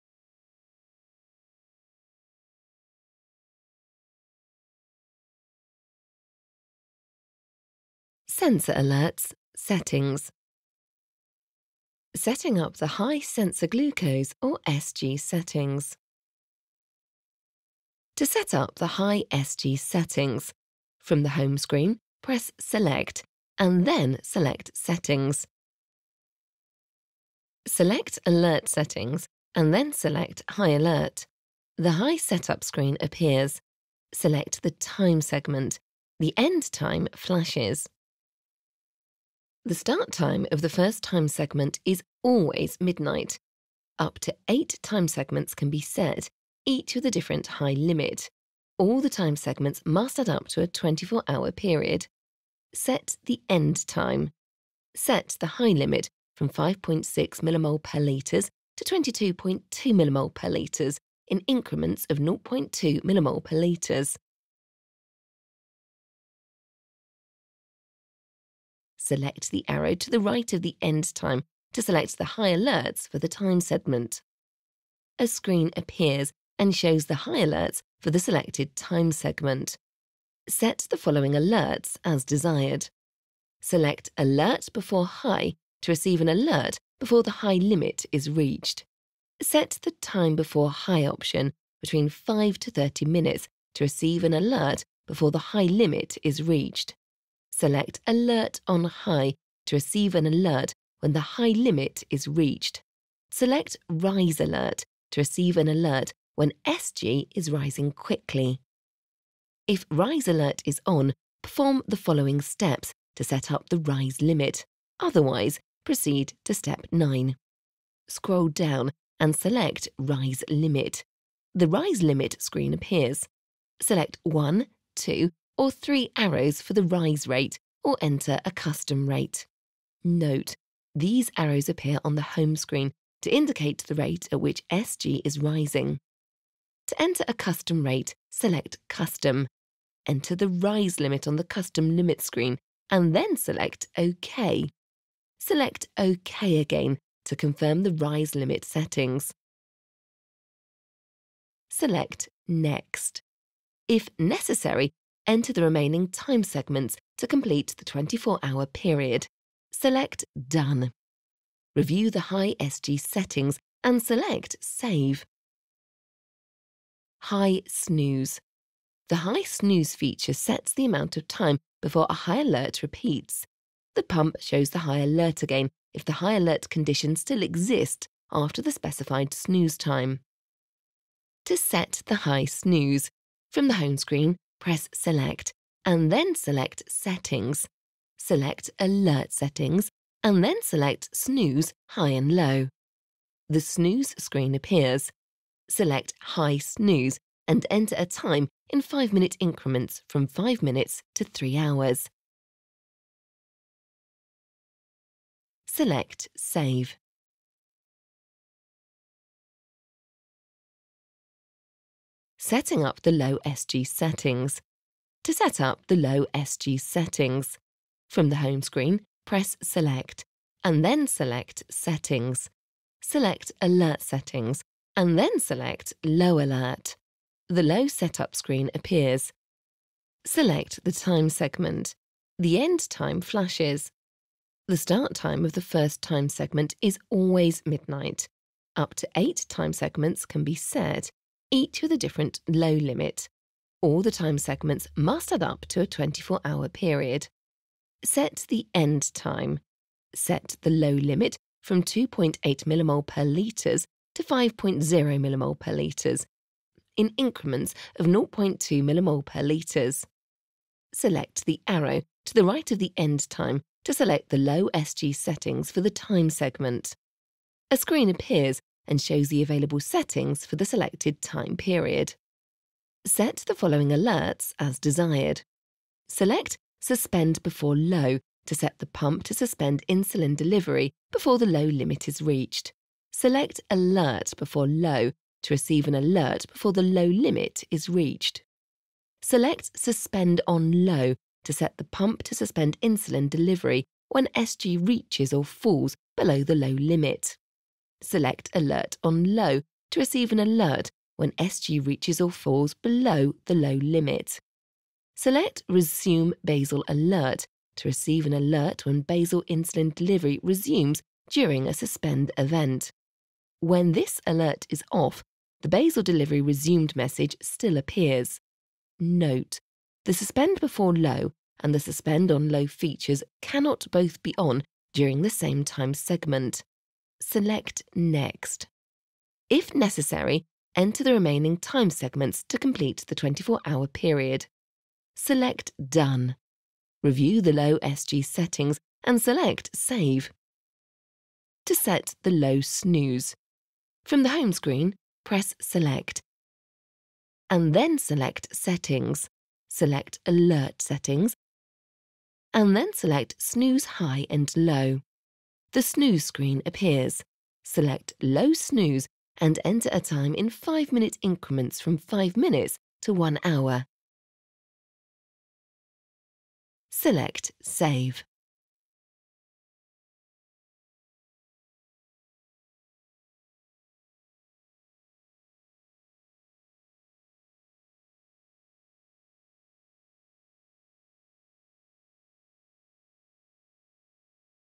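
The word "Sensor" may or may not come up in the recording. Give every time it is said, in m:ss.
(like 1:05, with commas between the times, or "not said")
0:08, 0:13.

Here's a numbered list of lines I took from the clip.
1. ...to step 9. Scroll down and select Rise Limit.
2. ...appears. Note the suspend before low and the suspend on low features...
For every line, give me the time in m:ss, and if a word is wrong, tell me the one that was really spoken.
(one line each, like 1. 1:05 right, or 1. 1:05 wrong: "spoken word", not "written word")
1. 1:56 right
2. 5:17 right.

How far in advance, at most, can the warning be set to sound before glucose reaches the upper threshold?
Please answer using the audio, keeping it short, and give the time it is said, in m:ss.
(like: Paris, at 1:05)
30 minutes, at 1:32.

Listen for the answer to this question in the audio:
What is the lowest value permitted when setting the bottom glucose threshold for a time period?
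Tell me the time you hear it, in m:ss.
4:11.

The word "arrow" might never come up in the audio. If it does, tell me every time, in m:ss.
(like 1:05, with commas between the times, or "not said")
1:09, 2:06, 2:11, 4:21.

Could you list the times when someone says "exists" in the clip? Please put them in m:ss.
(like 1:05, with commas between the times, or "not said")
2:57.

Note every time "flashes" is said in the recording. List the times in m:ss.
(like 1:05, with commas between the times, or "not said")
0:37, 3:53.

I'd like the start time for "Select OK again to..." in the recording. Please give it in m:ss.
2:25.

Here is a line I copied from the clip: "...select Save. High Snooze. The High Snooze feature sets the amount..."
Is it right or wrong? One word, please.
right.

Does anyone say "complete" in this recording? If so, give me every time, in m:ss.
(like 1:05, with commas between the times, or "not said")
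2:37, 5:32.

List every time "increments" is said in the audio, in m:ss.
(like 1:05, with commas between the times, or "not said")
1:01, 3:19, 4:17, 6:01.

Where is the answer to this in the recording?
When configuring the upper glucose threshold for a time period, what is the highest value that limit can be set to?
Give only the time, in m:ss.
0:58.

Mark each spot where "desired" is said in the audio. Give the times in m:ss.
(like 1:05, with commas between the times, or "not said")
1:22, 4:34.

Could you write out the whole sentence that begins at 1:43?
Select Rise Alert to receive an alert when SG is rising quickly.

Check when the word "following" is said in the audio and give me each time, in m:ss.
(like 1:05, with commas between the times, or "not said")
1:21, 1:52, 4:33.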